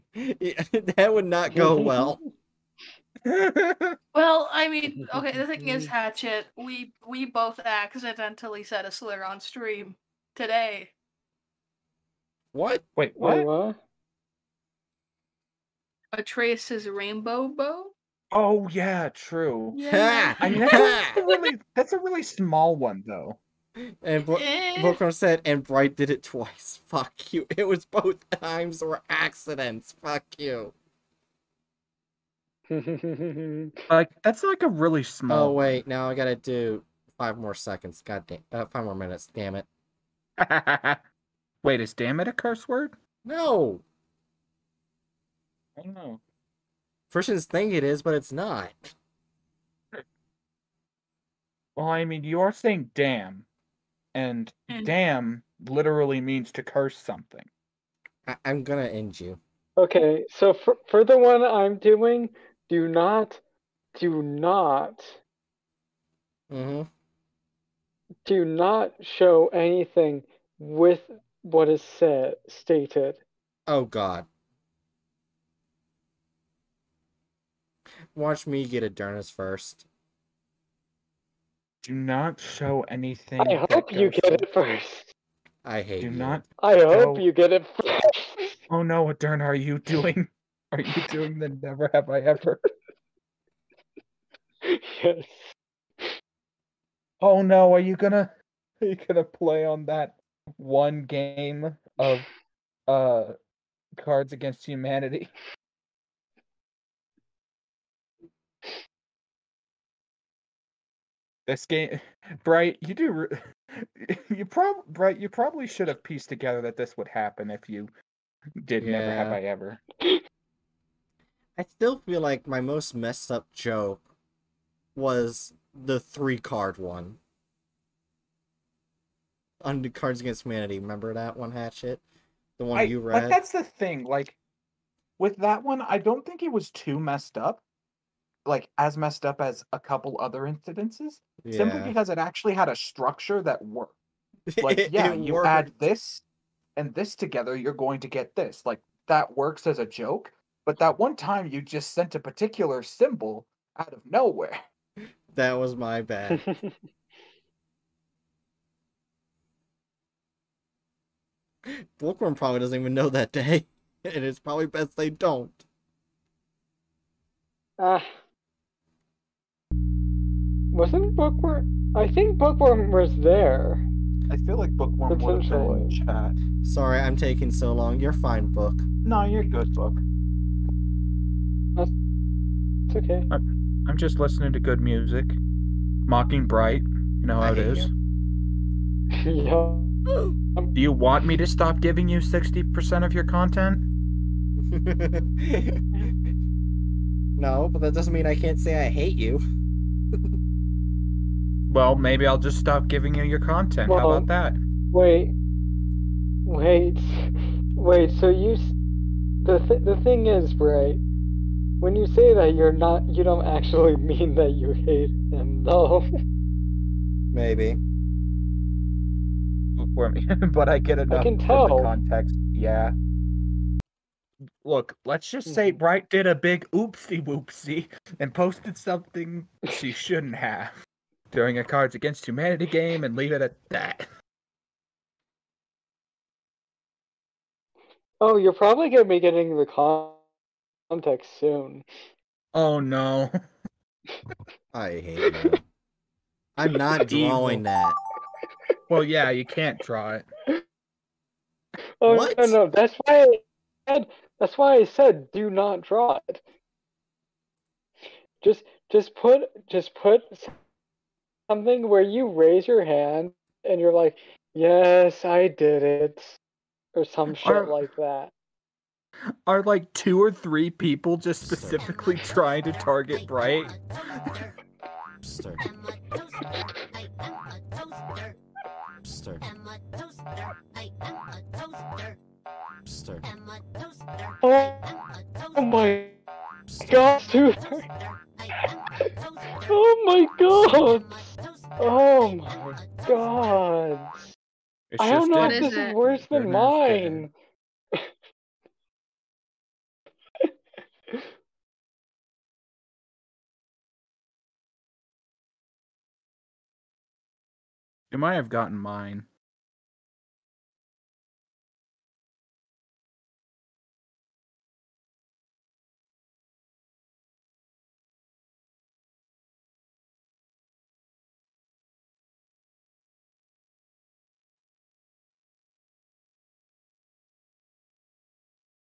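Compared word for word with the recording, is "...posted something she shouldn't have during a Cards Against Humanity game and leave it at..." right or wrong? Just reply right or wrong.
right.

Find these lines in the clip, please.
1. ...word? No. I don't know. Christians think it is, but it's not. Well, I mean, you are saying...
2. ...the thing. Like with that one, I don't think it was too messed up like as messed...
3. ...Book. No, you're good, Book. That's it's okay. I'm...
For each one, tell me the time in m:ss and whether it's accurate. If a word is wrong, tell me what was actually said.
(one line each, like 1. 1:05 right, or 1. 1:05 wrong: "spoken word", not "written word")
1. 0:42 right
2. 2:13 right
3. 2:58 right.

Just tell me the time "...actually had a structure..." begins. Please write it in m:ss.
2:22.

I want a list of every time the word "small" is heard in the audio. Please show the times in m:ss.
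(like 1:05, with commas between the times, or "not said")
0:22, 0:35.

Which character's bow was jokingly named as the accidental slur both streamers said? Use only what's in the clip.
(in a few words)
Atreus.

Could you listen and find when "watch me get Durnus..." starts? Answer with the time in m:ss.
1:18.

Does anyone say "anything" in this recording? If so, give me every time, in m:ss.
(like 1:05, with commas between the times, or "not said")
1:09, 1:22.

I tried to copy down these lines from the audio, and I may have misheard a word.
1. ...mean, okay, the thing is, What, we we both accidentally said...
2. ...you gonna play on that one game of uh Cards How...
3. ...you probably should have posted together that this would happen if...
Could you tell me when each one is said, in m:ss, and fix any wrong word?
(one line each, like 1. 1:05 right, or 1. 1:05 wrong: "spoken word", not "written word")
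1. 0:04 wrong: "Hatchet", not "What"
2. 1:38 wrong: "Against", not "How"
3. 1:55 wrong: "pieced", not "posted".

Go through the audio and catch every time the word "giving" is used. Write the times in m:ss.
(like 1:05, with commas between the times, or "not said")
3:11, 3:22.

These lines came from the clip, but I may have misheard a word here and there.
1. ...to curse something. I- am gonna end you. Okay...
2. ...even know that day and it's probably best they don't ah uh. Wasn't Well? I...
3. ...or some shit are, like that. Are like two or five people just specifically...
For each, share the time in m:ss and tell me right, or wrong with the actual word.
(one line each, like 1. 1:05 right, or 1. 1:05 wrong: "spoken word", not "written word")
1. 0:56 right
2. 2:42 wrong: "Bookworm", not "Well"
3. 4:26 wrong: "three", not "five".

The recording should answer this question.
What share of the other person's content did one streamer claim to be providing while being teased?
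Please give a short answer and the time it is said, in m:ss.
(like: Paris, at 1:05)
60%, at 3:12.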